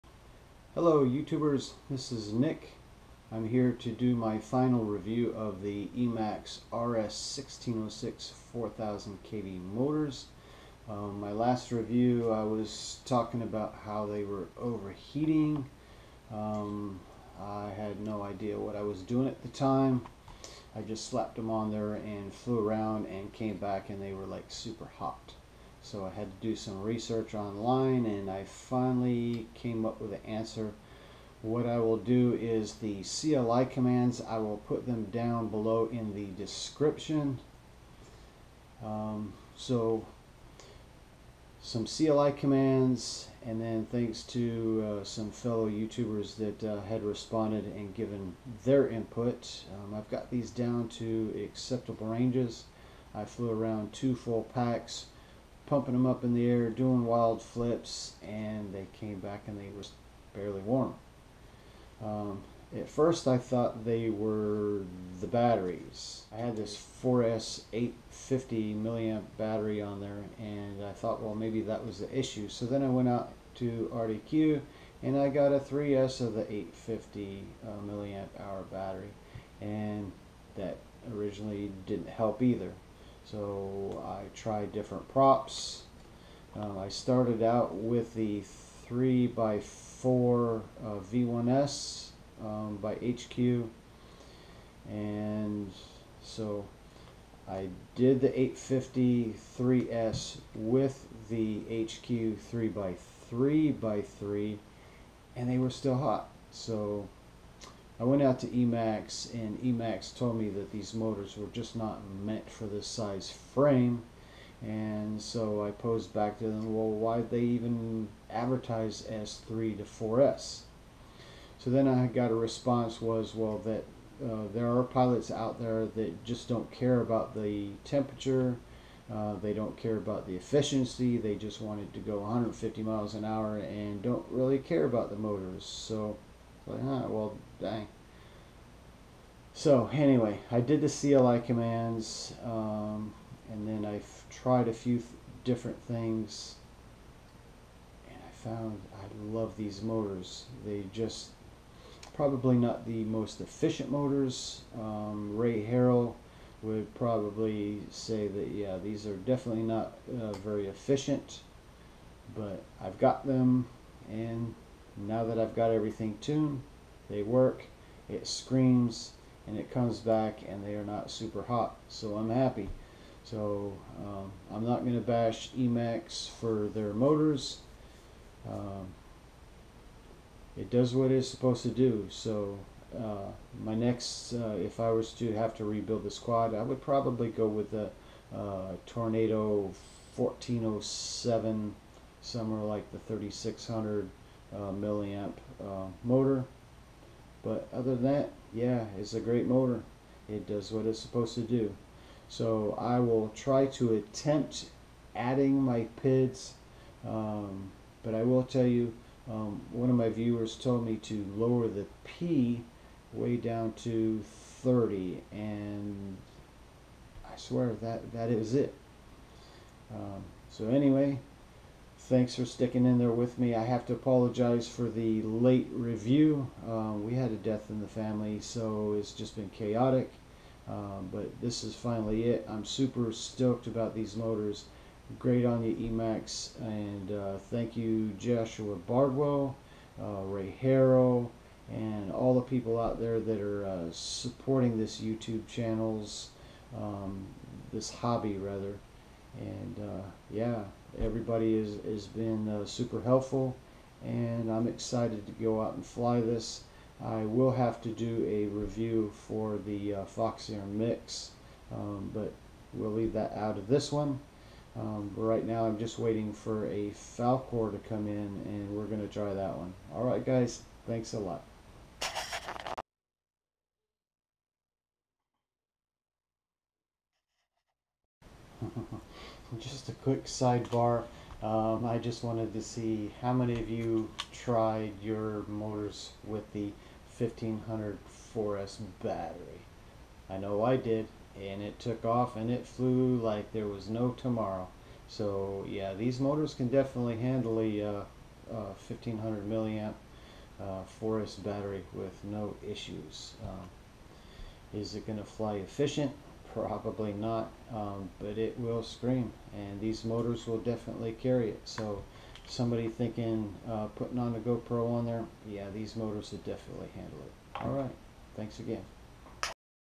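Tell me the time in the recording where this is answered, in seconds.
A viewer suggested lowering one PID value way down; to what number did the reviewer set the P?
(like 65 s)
214 s.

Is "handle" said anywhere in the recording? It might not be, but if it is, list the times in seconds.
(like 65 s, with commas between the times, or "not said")
297 s, 316 s.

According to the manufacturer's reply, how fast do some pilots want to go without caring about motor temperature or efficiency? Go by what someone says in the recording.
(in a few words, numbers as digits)
150 mph.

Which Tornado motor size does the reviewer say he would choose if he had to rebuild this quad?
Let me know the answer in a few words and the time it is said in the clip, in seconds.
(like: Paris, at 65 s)
1407, at 190 s.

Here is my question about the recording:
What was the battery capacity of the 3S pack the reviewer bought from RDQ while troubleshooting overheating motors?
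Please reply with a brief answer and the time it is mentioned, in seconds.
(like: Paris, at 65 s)
850 mAh, at 76 s.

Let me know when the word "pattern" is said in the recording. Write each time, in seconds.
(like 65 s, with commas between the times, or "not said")
not said.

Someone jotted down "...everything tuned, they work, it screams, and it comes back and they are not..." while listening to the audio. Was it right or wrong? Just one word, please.
right.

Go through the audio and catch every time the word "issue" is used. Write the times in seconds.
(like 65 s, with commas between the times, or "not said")
72 s, 302 s.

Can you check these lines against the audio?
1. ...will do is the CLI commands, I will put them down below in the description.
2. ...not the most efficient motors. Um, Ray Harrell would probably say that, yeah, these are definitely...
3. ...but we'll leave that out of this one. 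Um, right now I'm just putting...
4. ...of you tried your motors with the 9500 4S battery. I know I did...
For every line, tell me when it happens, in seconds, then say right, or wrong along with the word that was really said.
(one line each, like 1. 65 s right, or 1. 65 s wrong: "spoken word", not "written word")
1. 31 s right
2. 152 s right
3. 262 s wrong: "waiting", not "putting"
4. 283 s wrong: "1500", not "9500".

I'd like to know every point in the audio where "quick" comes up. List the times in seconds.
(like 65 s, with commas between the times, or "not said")
280 s.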